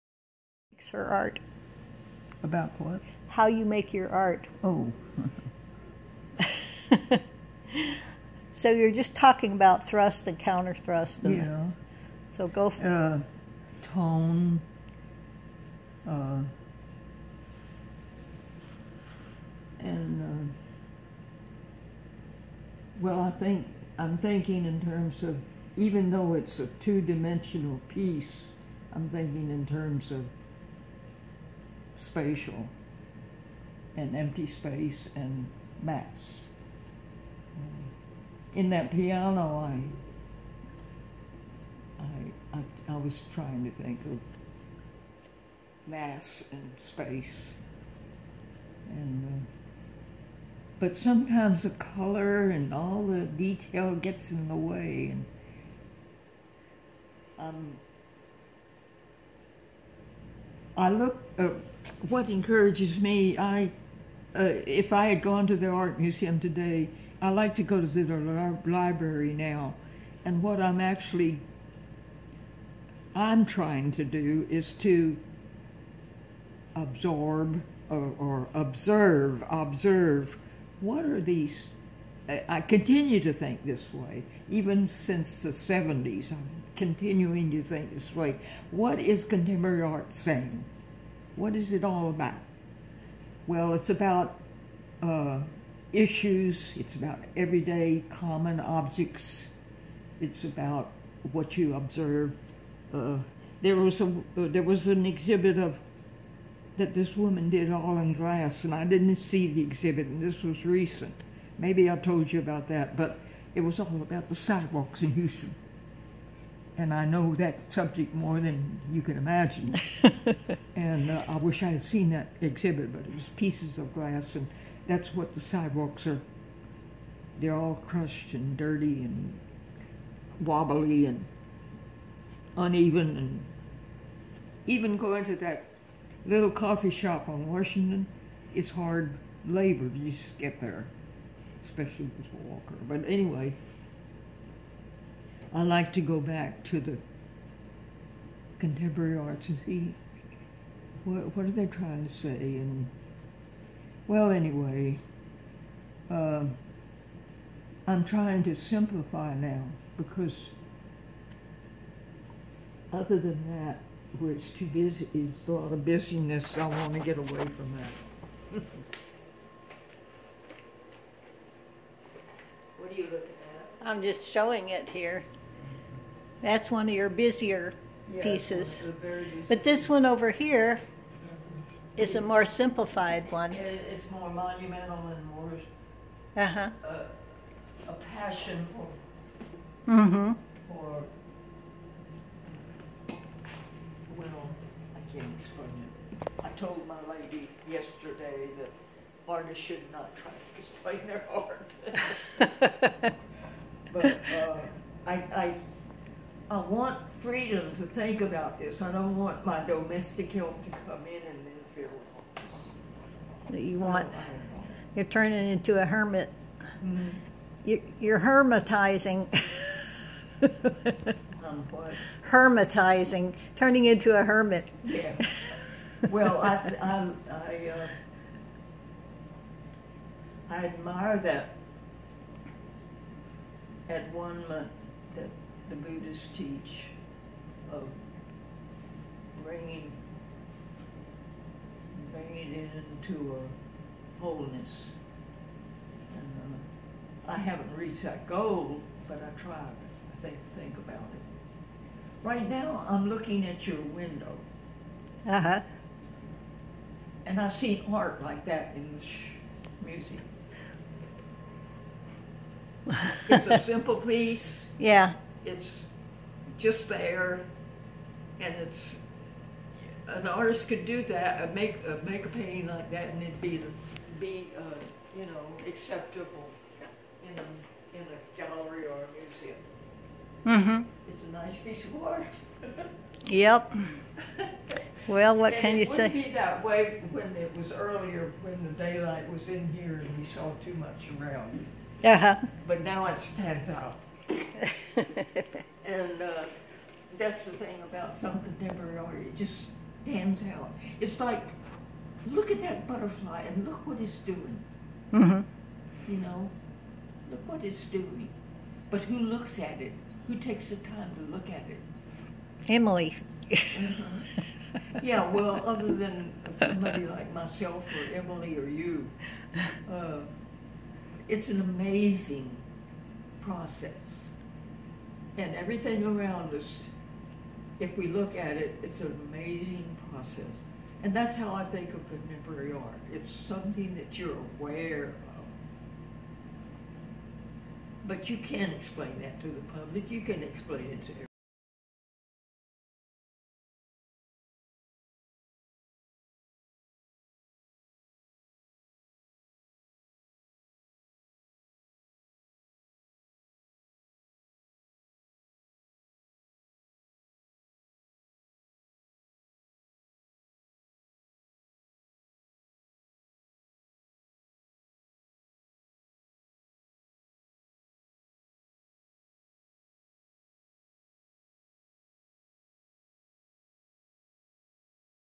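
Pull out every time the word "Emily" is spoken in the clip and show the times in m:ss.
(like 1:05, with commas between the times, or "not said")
5:12, 5:18.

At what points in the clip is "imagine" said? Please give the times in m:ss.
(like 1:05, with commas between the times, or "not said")
1:59.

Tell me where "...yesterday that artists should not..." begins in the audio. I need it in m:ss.
3:17.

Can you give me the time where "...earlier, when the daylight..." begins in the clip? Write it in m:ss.
4:47.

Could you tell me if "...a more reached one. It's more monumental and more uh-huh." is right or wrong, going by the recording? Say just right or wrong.
wrong.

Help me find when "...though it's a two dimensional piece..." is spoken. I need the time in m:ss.
0:26.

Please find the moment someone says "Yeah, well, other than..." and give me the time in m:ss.
5:15.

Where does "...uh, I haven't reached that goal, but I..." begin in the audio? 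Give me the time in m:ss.
4:06.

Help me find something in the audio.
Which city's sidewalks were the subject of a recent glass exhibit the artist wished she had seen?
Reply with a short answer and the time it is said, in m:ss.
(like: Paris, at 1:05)
Houston, at 1:55.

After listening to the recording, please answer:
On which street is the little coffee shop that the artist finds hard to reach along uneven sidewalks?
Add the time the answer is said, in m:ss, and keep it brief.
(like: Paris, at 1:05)
Washington, at 2:17.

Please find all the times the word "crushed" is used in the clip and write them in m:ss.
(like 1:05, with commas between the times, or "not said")
2:07.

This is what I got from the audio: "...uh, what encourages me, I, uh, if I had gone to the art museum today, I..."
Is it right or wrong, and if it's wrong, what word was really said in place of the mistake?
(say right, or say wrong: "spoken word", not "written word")
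right.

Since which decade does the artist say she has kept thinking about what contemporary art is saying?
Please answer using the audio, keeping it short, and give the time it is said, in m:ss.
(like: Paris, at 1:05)
the 70s, at 1:25.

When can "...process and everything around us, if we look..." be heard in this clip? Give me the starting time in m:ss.
5:23.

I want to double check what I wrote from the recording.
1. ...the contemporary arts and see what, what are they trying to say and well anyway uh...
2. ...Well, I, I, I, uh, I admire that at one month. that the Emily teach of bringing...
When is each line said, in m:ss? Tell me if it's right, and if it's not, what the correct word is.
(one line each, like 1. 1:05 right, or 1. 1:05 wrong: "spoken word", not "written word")
1. 2:26 right
2. 3:46 wrong: "Buddhists", not "Emily".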